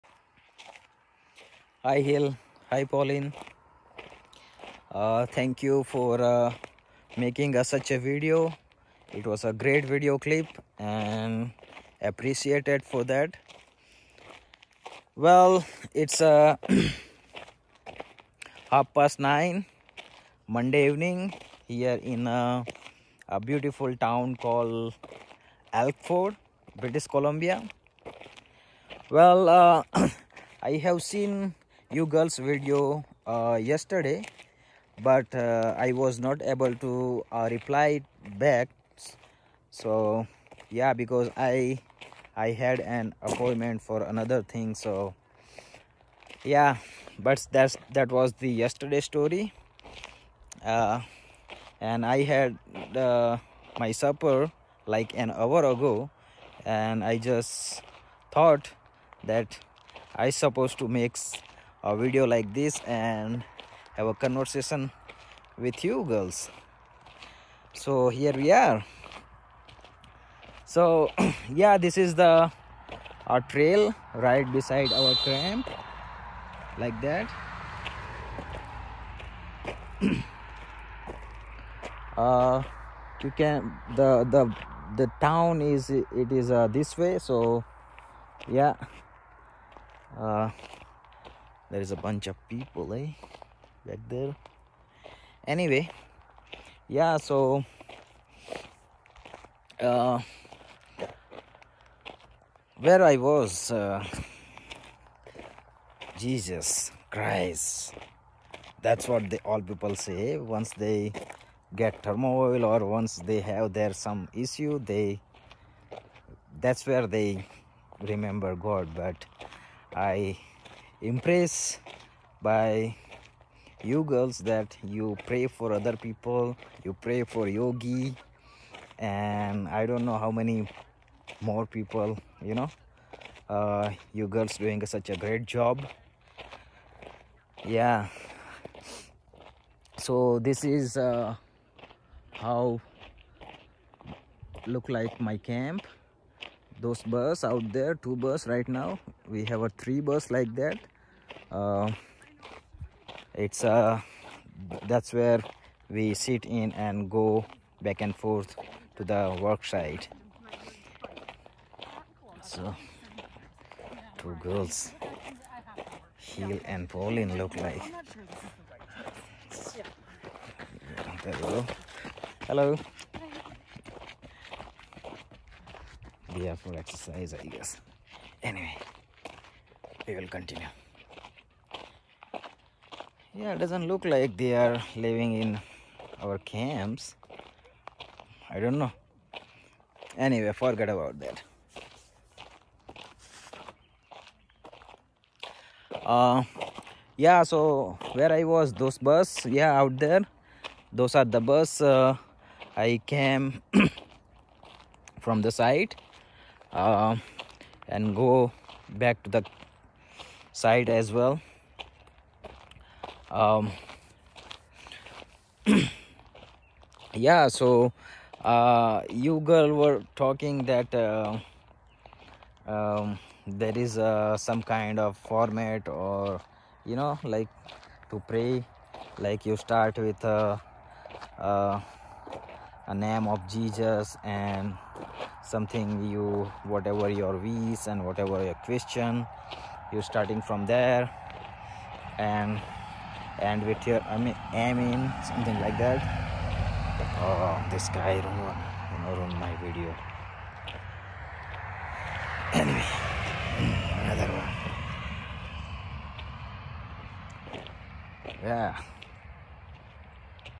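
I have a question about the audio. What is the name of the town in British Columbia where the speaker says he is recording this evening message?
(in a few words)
Elkford.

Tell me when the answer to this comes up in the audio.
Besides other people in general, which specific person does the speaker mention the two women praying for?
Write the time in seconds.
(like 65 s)
127 s.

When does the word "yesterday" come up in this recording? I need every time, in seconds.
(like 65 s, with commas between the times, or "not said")
33 s, 48 s.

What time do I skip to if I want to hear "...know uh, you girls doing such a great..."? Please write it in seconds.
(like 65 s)
132 s.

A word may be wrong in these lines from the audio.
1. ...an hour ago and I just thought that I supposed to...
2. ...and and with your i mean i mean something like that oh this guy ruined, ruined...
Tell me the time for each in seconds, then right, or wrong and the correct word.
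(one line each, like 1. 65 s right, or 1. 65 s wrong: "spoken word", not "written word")
1. 55 s right
2. 242 s right.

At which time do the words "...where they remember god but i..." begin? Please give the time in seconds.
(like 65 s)
116 s.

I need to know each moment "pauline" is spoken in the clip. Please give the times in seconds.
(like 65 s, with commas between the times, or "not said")
2 s, 166 s.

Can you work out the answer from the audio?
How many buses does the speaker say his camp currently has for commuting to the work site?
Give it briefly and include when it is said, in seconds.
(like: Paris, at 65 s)
3, at 149 s.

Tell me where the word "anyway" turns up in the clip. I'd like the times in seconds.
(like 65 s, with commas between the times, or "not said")
95 s, 178 s, 190 s, 252 s.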